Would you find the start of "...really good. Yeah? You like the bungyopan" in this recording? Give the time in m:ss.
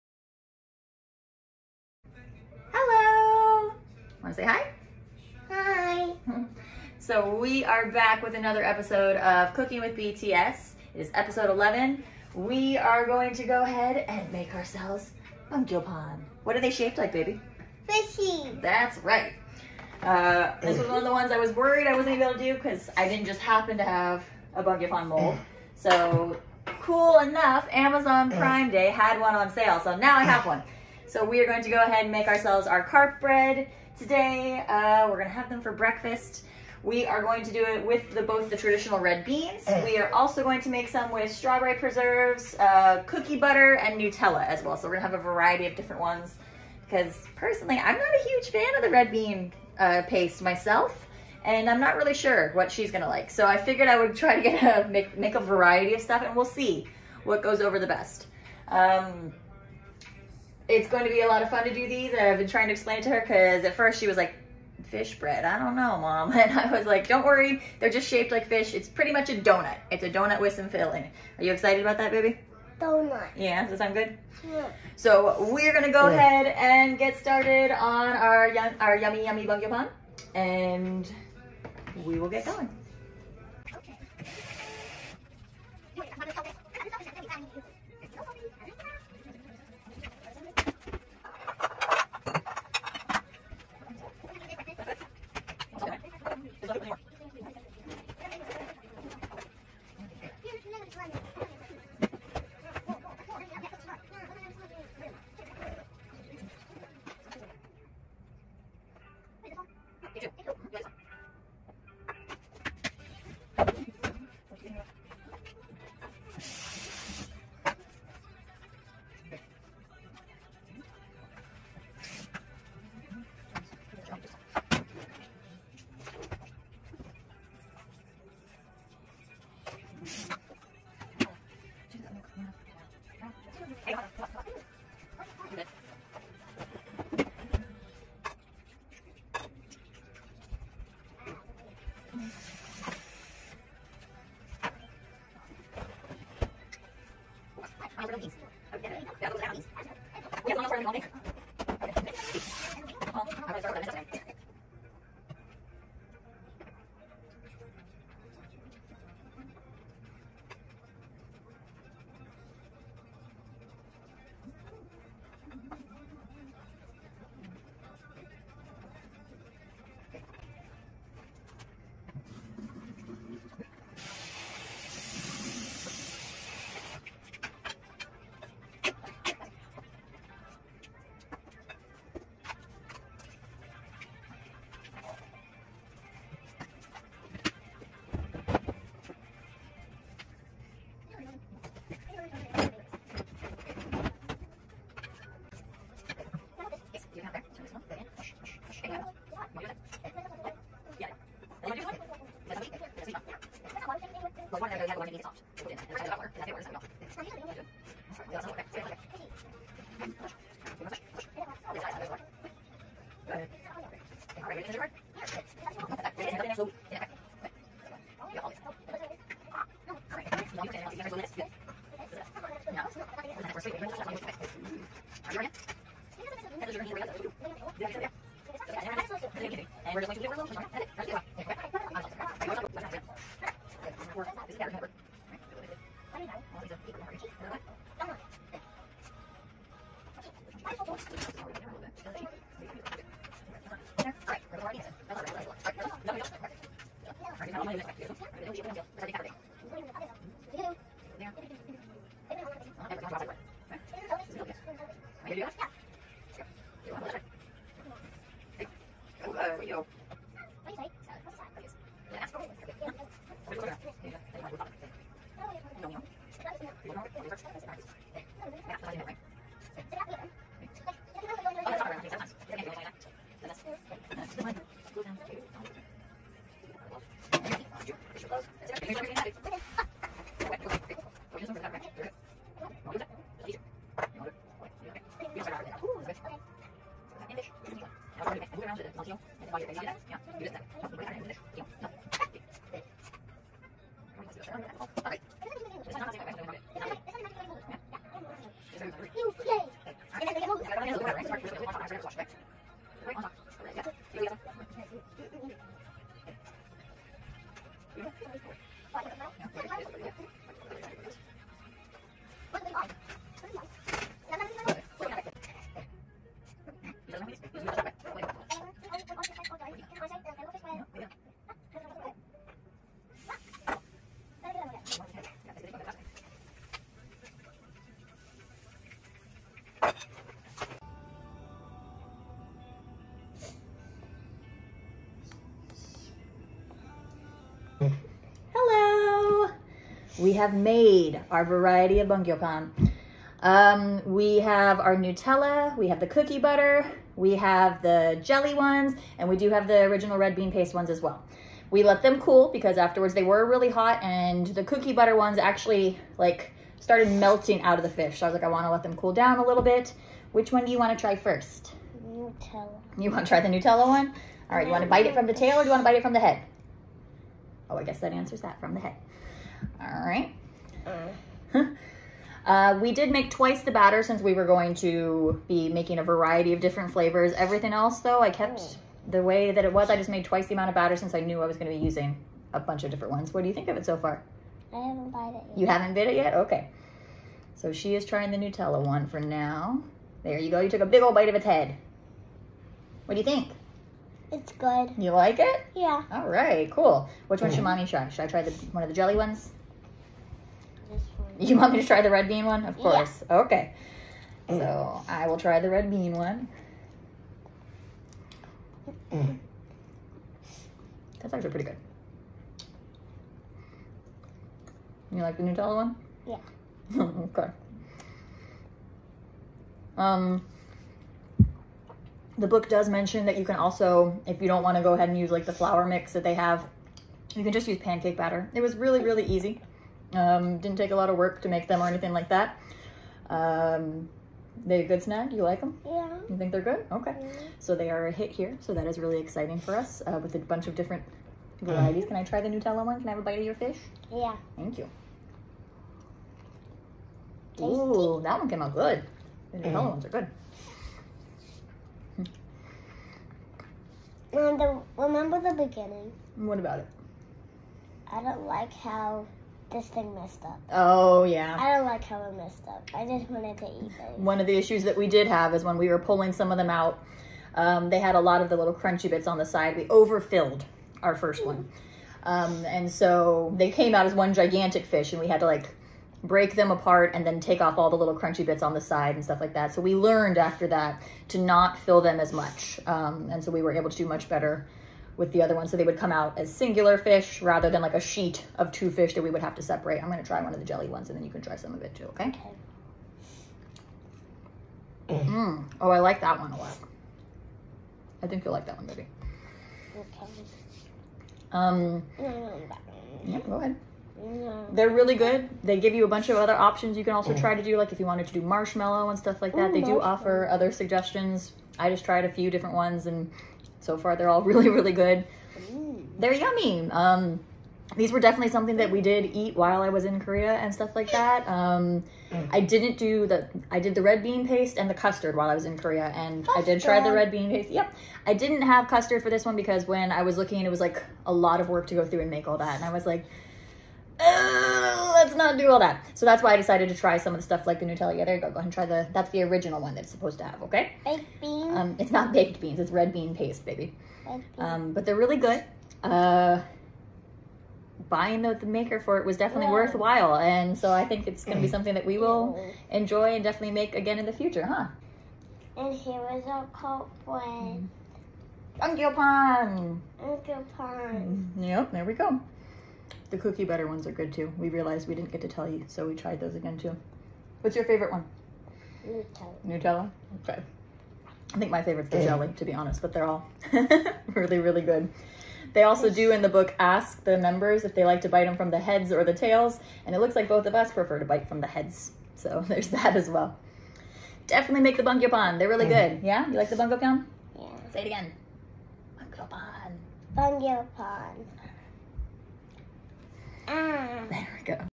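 9:45.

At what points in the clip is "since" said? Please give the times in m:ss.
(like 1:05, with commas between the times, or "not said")
6:14, 6:20.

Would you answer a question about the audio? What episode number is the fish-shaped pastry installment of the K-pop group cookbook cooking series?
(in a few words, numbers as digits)
11.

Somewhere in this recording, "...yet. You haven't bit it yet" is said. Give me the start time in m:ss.
6:25.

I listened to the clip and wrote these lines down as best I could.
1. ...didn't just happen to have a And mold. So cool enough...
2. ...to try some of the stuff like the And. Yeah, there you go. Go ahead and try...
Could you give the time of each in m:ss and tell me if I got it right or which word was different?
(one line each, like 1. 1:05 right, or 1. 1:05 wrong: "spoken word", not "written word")
1. 0:23 wrong: "Bungyopan", not "And"
2. 8:56 wrong: "Nutella", not "And".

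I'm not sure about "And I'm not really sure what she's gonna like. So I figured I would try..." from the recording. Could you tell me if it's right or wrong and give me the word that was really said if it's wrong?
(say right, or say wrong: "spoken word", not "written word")
right.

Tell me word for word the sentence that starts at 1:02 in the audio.
I've been trying to explain it to her because at first she was like, fish bread, I don't know, mom.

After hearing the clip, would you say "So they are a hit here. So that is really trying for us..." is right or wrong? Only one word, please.
wrong.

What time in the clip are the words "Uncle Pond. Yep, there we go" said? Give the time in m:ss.
9:20.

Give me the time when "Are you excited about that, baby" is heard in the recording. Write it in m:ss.
1:11.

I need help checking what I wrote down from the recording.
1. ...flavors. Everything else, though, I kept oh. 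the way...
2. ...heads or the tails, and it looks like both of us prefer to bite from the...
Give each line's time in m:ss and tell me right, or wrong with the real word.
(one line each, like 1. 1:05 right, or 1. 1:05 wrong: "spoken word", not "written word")
1. 6:16 right
2. 9:38 right.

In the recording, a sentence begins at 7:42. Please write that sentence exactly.
I just wanted to eat them.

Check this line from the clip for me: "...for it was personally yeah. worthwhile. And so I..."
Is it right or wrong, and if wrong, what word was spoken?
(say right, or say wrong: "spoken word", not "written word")
wrong: "definitely", not "personally".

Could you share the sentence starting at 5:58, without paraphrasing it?
So I was like, I want to let them cool down a little bit.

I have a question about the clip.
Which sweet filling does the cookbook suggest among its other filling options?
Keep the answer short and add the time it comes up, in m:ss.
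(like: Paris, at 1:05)
Marshmallow, at 8:28.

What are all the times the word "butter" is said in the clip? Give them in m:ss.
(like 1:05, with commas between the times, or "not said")
0:43, 5:46, 5:54, 9:23.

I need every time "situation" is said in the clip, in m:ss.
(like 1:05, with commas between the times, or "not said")
not said.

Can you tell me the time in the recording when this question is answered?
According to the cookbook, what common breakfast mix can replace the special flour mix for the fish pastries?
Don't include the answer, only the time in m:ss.
7:07.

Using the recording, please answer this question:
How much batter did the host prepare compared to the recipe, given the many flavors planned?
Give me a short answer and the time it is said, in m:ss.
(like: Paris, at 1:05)
Twice the amount, at 6:13.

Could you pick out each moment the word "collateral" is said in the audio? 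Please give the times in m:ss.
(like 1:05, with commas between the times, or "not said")
not said.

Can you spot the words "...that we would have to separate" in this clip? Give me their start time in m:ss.
8:09.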